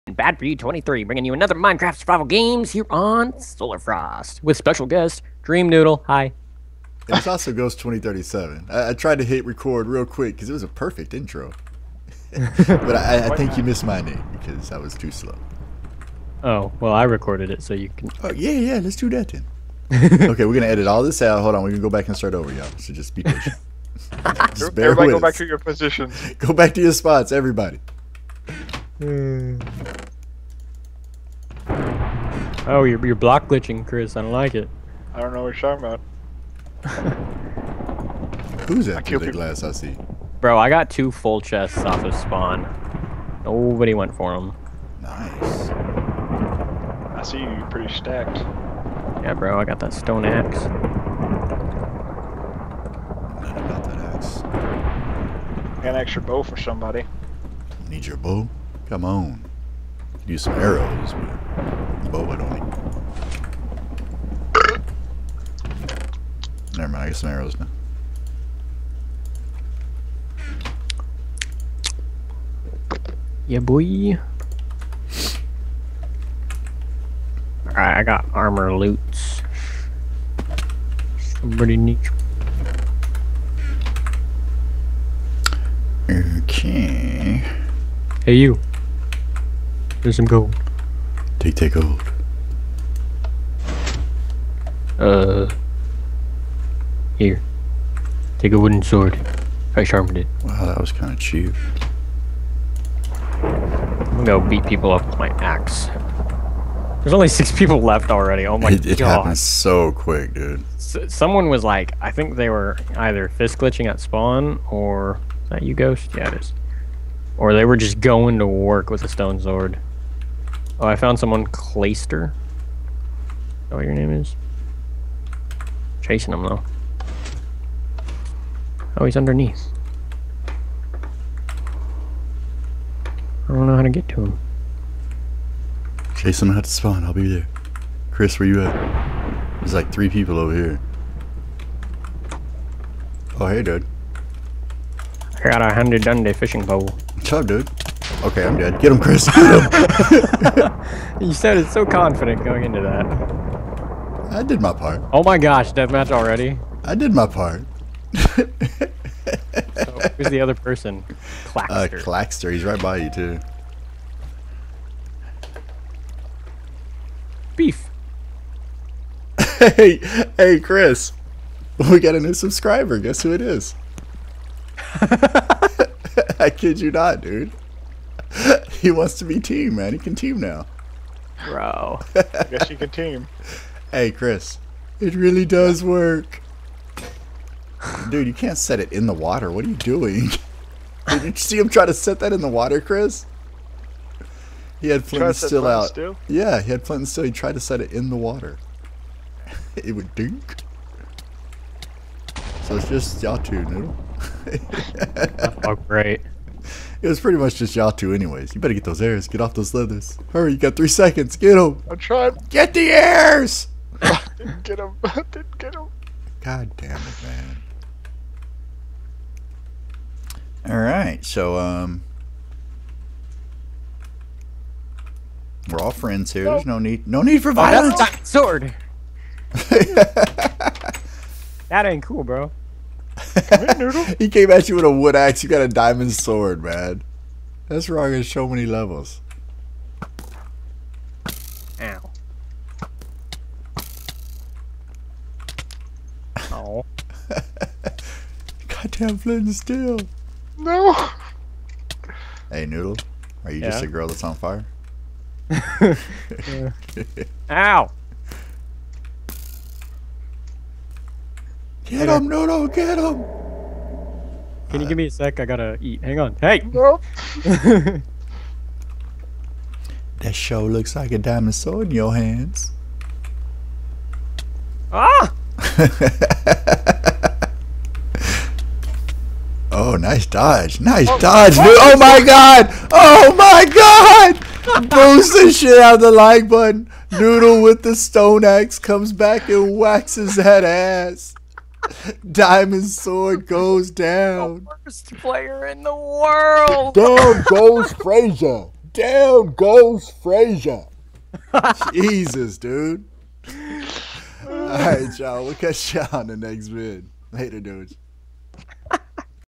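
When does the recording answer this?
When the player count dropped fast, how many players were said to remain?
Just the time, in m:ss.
1:47.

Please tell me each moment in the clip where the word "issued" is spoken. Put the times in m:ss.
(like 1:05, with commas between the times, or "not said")
not said.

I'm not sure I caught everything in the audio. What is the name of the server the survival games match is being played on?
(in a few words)
Solar Frost.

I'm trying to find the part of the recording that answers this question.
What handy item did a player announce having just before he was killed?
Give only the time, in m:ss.
2:26.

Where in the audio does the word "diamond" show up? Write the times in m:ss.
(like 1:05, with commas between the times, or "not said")
3:55, 4:31, 4:52.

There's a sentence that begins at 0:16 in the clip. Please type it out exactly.
Oh well, I recorded it, so you can.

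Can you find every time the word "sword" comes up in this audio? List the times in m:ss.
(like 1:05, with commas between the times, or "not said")
1:38, 1:59, 3:48, 3:56, 4:31, 4:52.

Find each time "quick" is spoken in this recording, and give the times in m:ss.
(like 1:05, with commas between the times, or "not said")
0:10, 1:49.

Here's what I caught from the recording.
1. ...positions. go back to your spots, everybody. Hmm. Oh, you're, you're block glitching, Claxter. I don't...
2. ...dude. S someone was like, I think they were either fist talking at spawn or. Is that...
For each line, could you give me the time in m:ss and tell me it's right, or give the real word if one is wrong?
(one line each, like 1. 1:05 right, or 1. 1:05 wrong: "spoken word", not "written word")
1. 0:25 wrong: "Chris", not "Claxter"
2. 1:50 wrong: "glitching", not "talking".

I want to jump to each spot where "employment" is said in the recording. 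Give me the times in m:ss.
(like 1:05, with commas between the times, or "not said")
not said.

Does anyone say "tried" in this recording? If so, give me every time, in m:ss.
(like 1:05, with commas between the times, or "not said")
0:08, 3:17.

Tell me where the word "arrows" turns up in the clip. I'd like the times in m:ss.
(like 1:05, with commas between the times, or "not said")
1:00, 1:07.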